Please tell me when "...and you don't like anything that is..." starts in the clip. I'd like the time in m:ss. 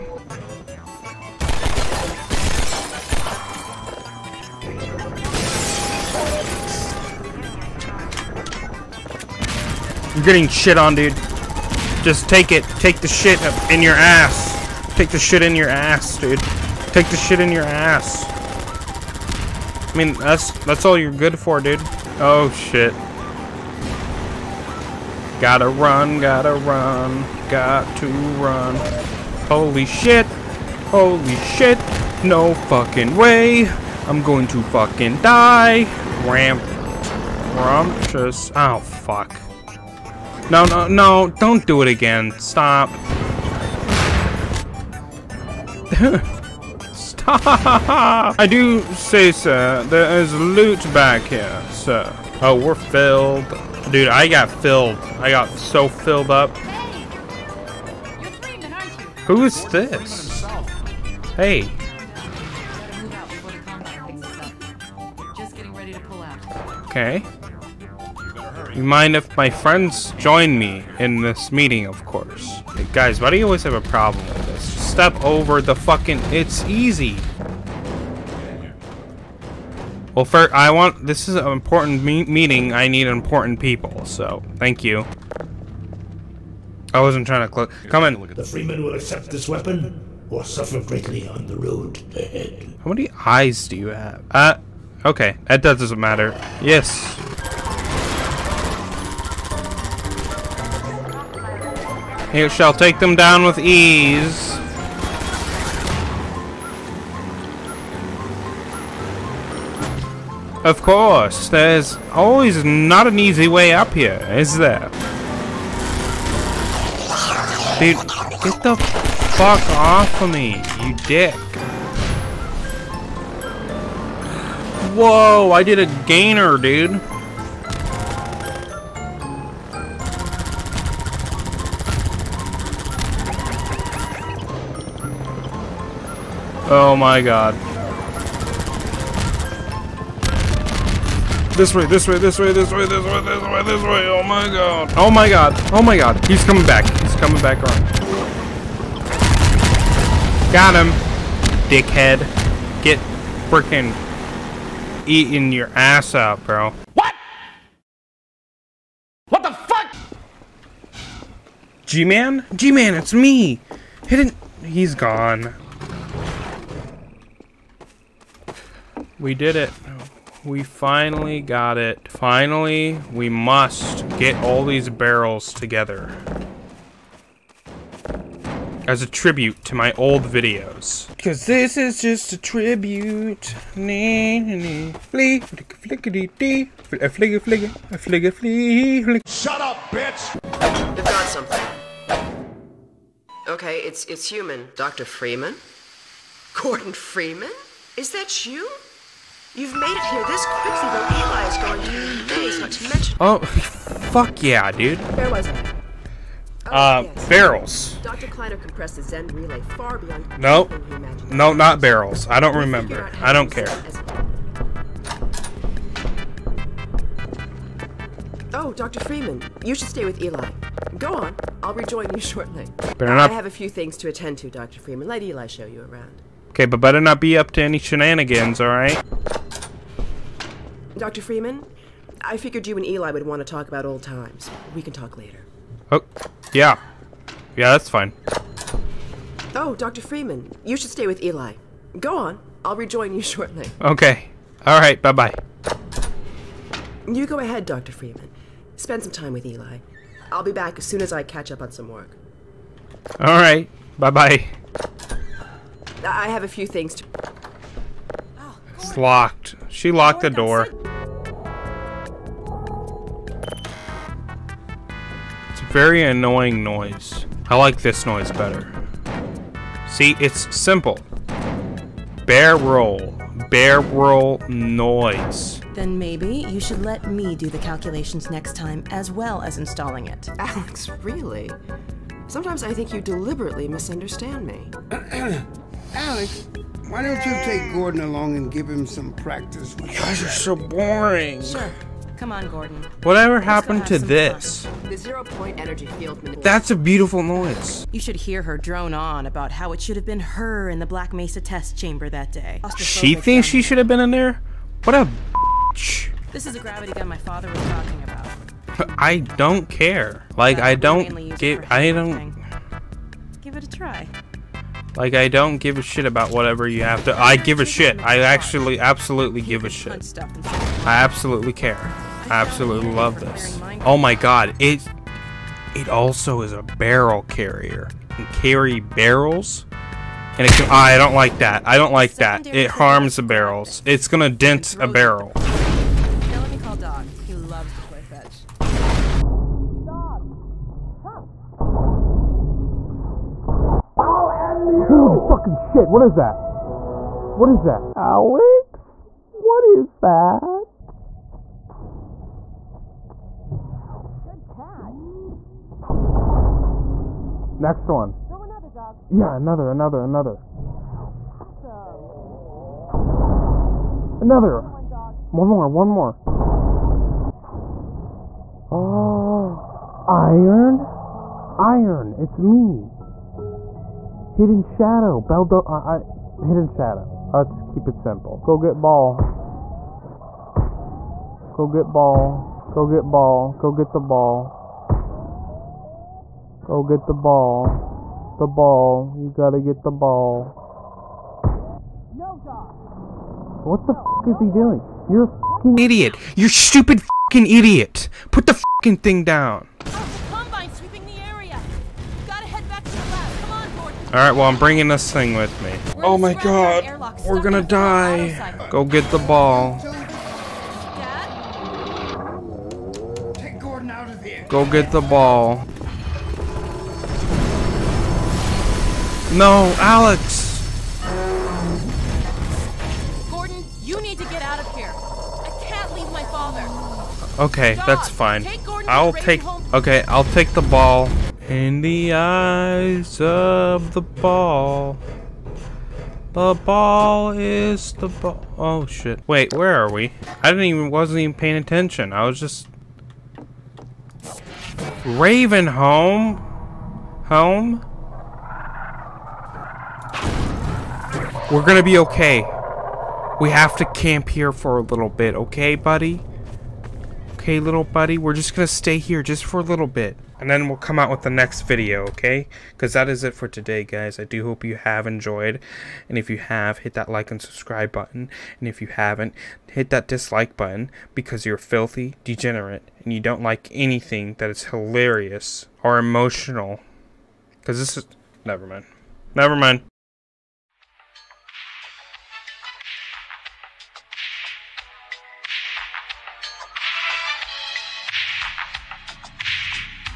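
7:53.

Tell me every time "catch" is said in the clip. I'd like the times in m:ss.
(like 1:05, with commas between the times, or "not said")
4:11, 5:54.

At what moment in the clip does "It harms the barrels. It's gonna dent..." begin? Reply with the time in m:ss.
5:32.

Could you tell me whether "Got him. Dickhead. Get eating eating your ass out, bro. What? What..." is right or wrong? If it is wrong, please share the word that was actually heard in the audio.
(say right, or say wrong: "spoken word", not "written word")
wrong: "freaking", not "eating".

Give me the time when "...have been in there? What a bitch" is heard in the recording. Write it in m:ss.
5:03.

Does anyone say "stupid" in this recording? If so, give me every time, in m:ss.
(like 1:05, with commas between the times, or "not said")
6:36.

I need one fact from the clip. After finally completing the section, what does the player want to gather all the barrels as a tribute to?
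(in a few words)
My old videos.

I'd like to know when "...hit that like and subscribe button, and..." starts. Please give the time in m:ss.
7:46.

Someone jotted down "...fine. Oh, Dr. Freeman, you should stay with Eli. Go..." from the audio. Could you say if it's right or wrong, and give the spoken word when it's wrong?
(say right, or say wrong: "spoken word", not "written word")
right.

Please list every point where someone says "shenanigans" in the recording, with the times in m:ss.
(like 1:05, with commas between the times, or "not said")
3:47.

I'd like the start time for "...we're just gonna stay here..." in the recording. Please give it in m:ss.
7:38.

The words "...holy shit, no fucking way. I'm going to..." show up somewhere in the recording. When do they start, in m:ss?
0:30.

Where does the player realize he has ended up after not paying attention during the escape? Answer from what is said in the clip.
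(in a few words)
Ravenholm.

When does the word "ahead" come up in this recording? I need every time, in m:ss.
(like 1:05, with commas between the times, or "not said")
1:32, 4:07.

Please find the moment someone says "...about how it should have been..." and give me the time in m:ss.
4:59.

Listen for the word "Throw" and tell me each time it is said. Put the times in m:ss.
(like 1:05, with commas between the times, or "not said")
5:58.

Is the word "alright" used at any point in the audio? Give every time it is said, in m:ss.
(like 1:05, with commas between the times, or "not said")
3:48, 6:44.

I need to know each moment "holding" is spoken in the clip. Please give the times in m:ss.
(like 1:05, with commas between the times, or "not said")
not said.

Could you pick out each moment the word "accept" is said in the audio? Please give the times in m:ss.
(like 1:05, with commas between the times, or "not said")
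1:28.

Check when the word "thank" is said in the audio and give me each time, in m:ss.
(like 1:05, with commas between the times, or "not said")
1:24.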